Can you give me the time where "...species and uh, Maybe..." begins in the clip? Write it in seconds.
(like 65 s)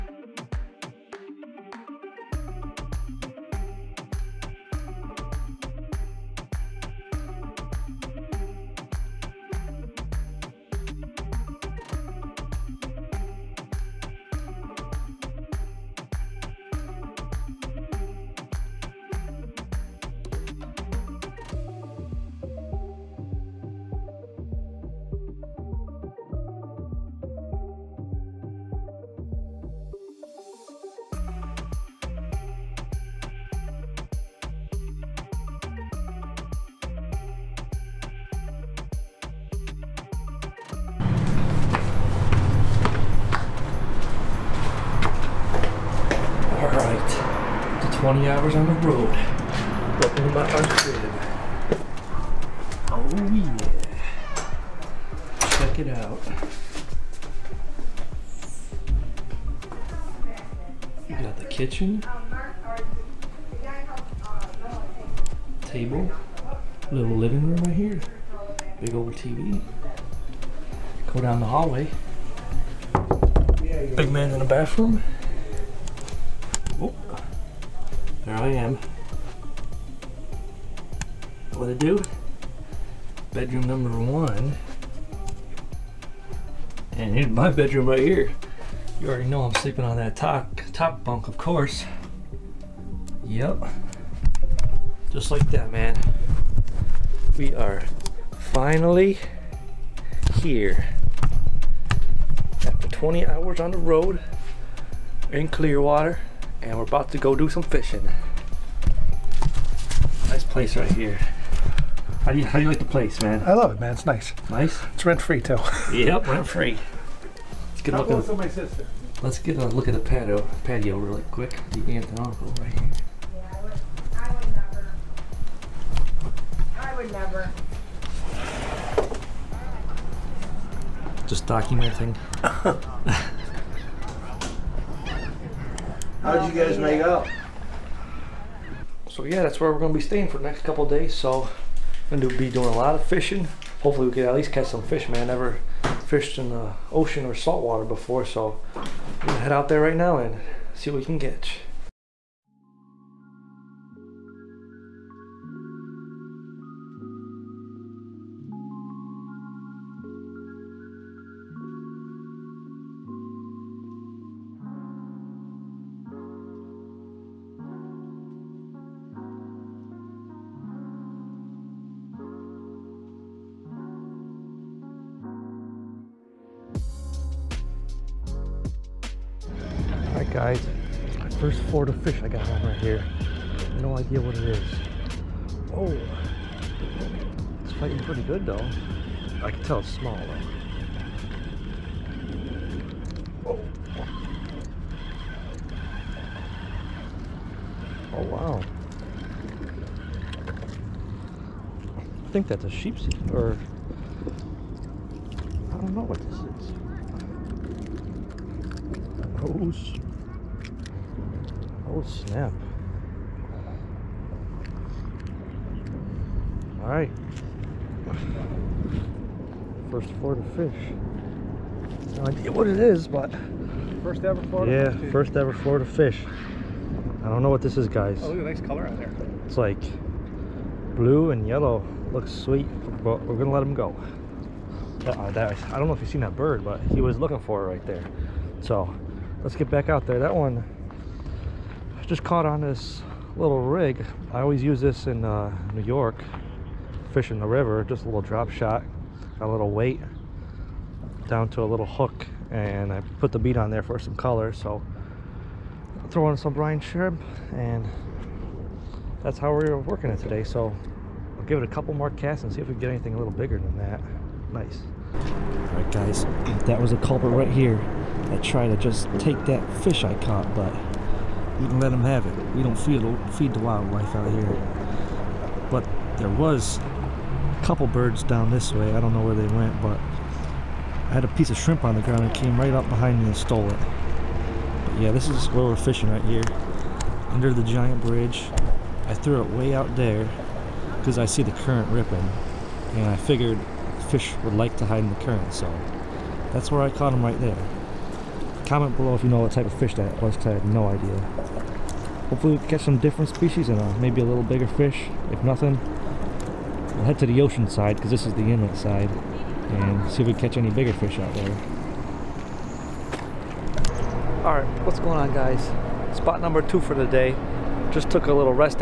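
303 s.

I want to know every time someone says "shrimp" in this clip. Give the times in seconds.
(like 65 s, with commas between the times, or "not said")
256 s, 281 s.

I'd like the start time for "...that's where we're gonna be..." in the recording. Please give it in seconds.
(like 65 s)
139 s.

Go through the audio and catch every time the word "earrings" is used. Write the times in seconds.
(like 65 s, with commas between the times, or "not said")
not said.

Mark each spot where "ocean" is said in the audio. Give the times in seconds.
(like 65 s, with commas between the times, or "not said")
146 s, 307 s.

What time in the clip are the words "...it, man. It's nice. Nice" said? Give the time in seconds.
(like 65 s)
113 s.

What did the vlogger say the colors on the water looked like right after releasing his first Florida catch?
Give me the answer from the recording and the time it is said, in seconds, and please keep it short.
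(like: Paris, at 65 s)
blue and yellow, at 230 s.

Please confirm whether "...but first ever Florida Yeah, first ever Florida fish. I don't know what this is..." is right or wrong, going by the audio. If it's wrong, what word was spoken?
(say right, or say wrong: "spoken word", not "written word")
right.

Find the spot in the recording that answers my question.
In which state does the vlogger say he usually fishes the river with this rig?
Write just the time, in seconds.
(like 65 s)
245 s.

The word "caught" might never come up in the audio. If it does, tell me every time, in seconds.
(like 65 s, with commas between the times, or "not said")
242 s, 270 s, 296 s.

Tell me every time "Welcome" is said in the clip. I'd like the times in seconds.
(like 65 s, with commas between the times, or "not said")
49 s.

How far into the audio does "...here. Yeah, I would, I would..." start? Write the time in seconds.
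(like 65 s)
122 s.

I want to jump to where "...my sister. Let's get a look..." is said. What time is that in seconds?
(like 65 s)
118 s.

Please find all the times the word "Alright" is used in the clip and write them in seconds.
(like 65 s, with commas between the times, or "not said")
216 s, 314 s.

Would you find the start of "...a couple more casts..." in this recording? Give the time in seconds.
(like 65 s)
261 s.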